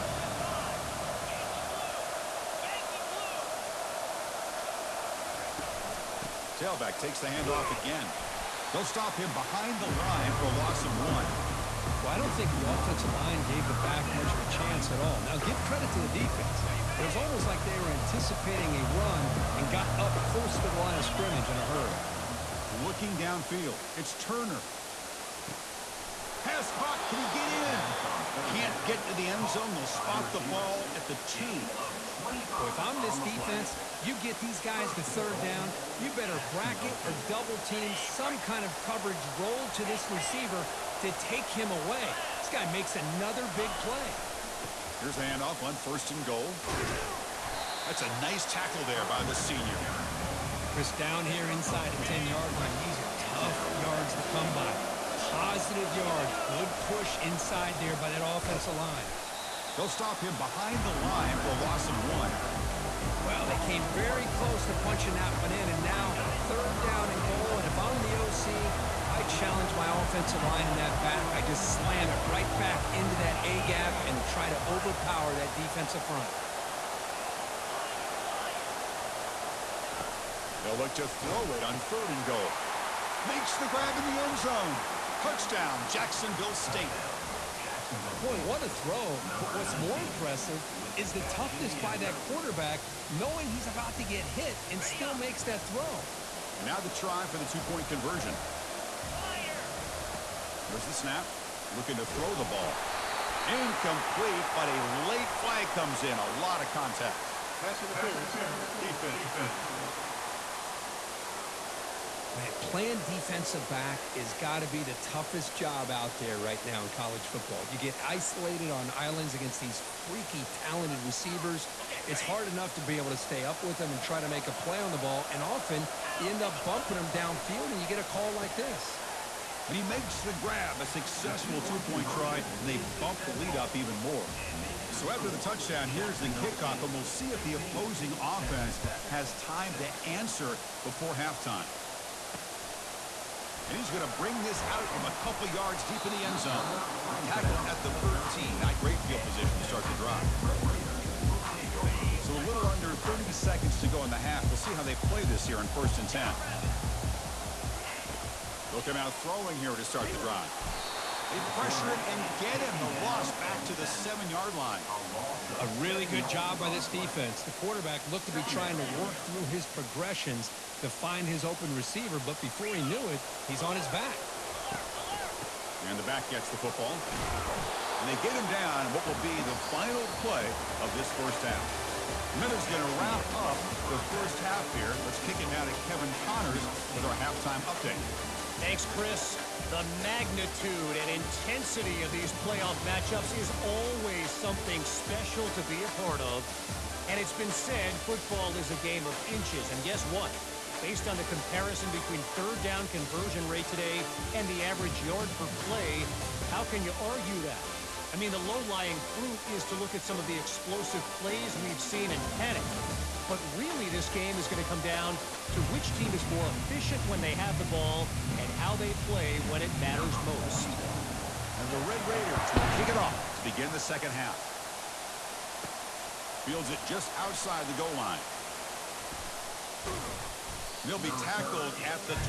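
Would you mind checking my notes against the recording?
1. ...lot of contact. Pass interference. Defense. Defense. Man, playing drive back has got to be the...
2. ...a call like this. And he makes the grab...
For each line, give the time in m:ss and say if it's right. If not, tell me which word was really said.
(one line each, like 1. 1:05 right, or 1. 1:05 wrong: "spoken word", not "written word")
1. 1:46 wrong: "defensive", not "drive"
2. 2:08 right.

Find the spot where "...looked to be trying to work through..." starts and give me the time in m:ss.
2:48.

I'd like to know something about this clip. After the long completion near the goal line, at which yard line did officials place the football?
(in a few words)
2.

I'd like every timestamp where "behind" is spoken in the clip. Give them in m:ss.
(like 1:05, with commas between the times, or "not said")
0:09, 1:00.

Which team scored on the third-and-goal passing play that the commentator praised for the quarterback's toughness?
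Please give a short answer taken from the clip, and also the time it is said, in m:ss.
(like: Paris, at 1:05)
Jacksonville State, at 1:25.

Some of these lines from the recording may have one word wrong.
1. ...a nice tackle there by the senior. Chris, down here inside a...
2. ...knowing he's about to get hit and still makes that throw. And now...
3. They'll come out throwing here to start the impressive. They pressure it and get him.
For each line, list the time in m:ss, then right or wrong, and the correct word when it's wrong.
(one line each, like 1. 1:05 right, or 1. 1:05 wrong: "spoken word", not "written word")
1. 0:48 right
2. 1:33 right
3. 2:38 wrong: "drive", not "impressive".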